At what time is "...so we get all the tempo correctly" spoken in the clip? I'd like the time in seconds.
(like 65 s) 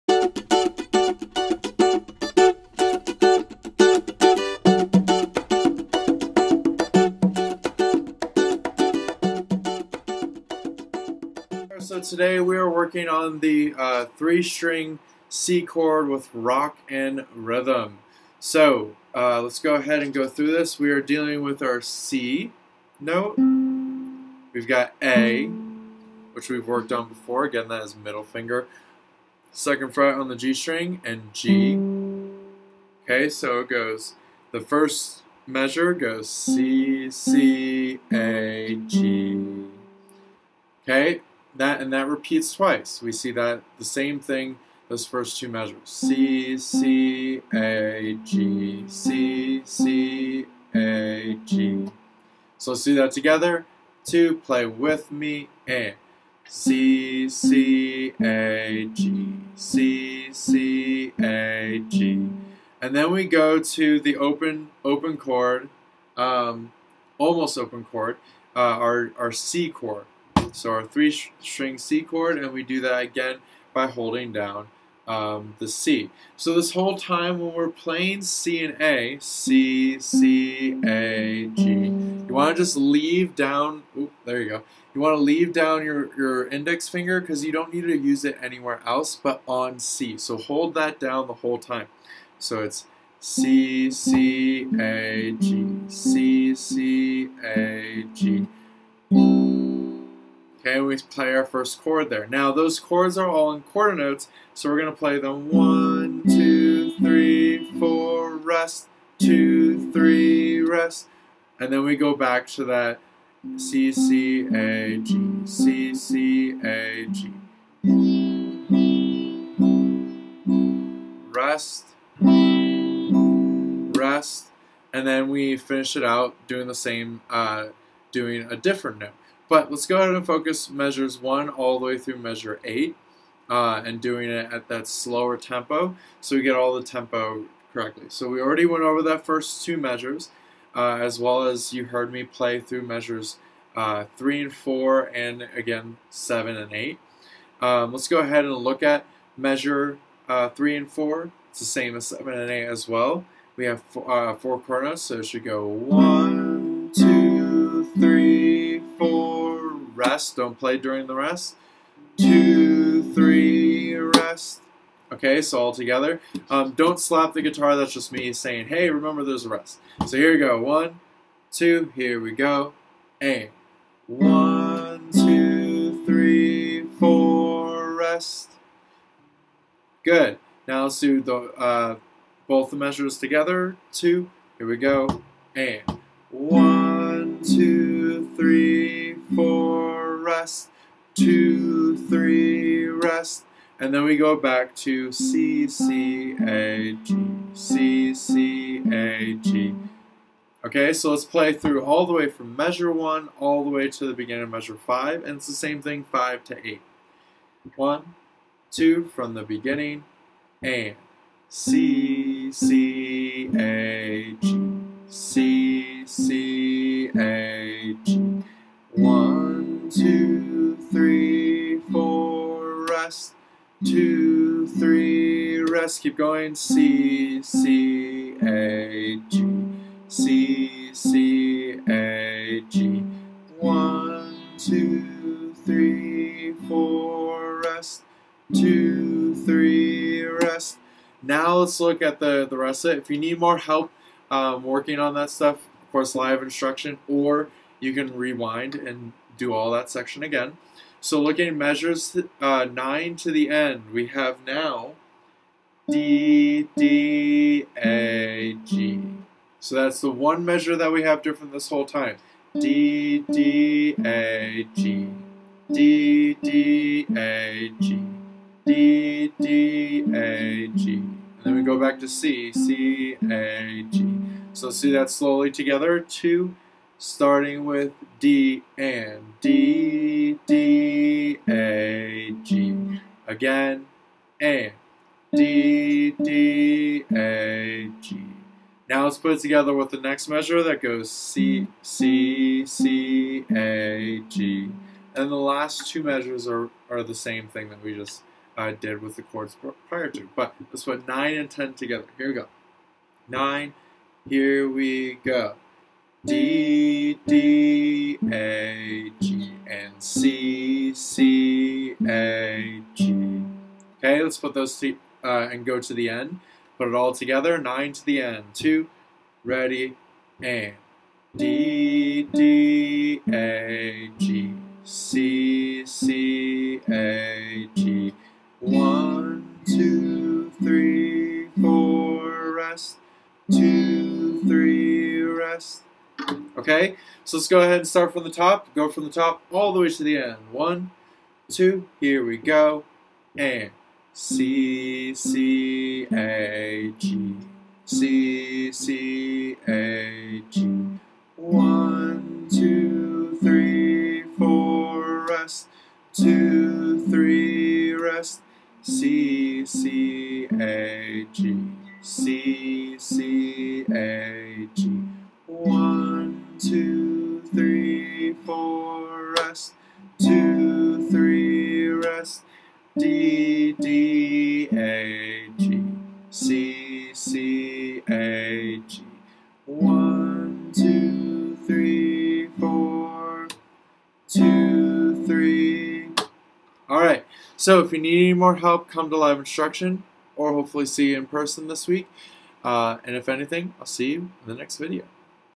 136 s.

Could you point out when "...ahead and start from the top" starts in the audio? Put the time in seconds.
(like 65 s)
337 s.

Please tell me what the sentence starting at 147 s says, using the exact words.
Um, let's go ahead and look at measure uh, 3 and 4.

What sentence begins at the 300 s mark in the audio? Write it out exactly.
But let's put 9 and 10 together.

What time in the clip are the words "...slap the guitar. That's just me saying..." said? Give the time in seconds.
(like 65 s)
166 s.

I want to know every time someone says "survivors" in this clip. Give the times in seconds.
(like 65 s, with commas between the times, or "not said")
not said.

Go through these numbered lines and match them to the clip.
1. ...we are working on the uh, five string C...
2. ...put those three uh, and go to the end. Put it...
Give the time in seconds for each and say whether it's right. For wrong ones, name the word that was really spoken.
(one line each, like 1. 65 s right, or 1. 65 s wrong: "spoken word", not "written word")
1. 12 s wrong: "three", not "five"
2. 314 s right.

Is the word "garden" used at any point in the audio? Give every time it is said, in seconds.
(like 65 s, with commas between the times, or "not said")
not said.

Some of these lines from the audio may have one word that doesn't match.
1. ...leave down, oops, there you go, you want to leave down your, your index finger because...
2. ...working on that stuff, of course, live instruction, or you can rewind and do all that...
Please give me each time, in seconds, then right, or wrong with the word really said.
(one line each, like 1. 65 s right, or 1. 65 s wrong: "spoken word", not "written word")
1. 82 s right
2. 244 s right.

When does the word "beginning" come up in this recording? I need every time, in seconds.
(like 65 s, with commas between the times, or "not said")
204 s, 209 s.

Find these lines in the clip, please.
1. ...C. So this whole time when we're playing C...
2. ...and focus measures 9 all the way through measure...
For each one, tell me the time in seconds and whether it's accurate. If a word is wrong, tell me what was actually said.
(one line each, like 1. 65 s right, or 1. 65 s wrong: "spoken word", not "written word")
1. 75 s right
2. 130 s wrong: "1", not "9".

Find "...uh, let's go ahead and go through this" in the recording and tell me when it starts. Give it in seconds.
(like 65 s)
19 s.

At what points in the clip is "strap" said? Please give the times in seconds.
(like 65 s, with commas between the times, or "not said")
not said.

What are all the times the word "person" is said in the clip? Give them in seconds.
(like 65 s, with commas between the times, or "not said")
391 s.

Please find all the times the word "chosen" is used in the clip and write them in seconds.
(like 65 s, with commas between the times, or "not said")
not said.